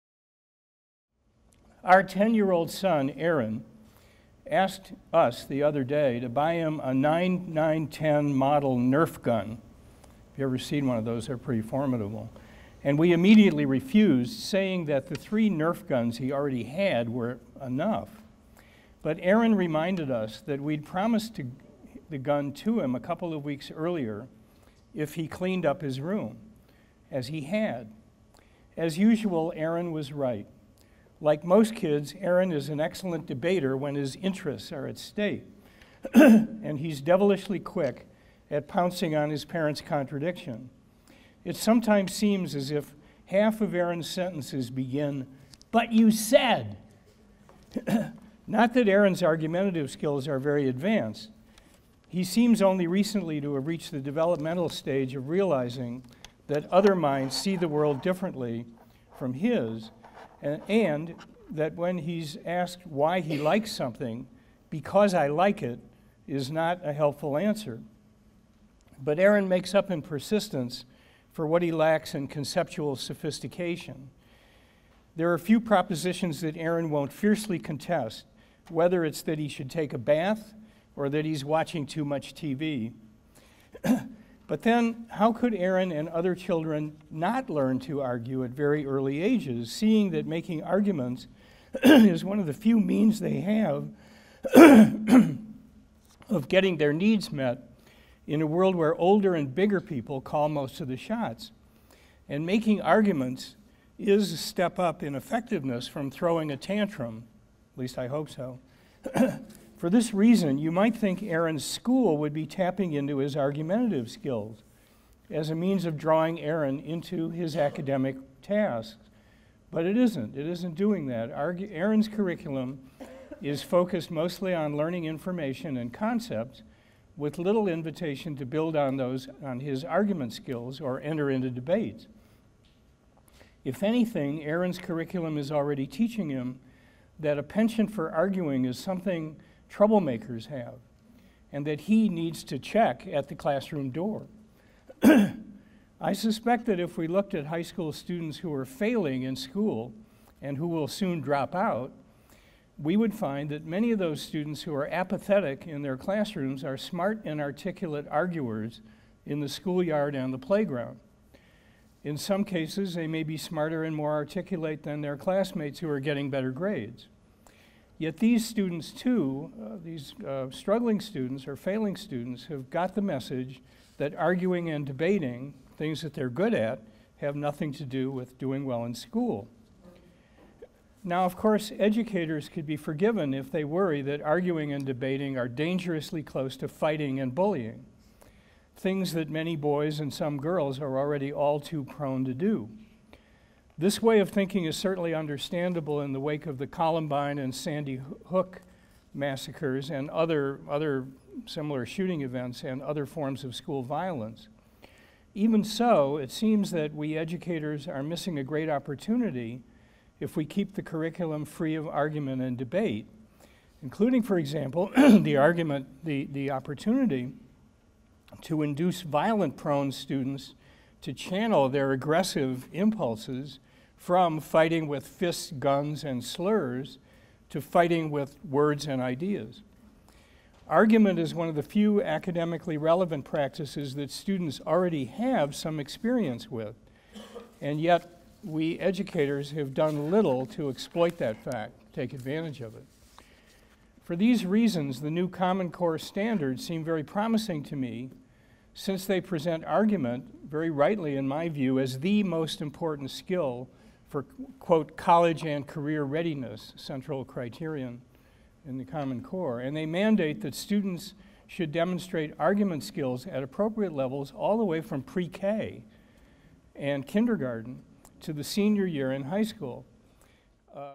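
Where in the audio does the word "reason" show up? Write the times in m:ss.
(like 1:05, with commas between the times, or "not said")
1:50, 4:04.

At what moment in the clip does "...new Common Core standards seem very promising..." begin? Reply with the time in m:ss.
4:05.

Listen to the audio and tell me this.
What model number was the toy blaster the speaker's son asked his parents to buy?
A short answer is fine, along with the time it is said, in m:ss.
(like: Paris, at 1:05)
9910, at 0:06.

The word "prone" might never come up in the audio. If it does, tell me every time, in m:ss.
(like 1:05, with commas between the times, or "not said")
3:11, 3:39.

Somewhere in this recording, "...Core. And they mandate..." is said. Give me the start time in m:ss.
4:19.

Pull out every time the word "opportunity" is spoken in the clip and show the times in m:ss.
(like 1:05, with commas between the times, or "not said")
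3:28, 3:36.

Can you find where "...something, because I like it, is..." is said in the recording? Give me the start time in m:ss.
1:03.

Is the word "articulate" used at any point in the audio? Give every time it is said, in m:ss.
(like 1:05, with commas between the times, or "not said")
2:37, 2:44.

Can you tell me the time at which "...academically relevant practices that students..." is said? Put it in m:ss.
3:52.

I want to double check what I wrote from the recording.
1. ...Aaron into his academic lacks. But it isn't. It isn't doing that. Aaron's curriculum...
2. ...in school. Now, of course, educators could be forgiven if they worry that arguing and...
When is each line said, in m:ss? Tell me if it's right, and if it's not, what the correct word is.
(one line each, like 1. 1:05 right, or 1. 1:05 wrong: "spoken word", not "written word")
1. 1:56 wrong: "tasks", not "lacks"
2. 2:58 right.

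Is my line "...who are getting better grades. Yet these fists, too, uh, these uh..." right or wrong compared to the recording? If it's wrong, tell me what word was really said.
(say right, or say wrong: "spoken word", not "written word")
wrong: "students", not "fists".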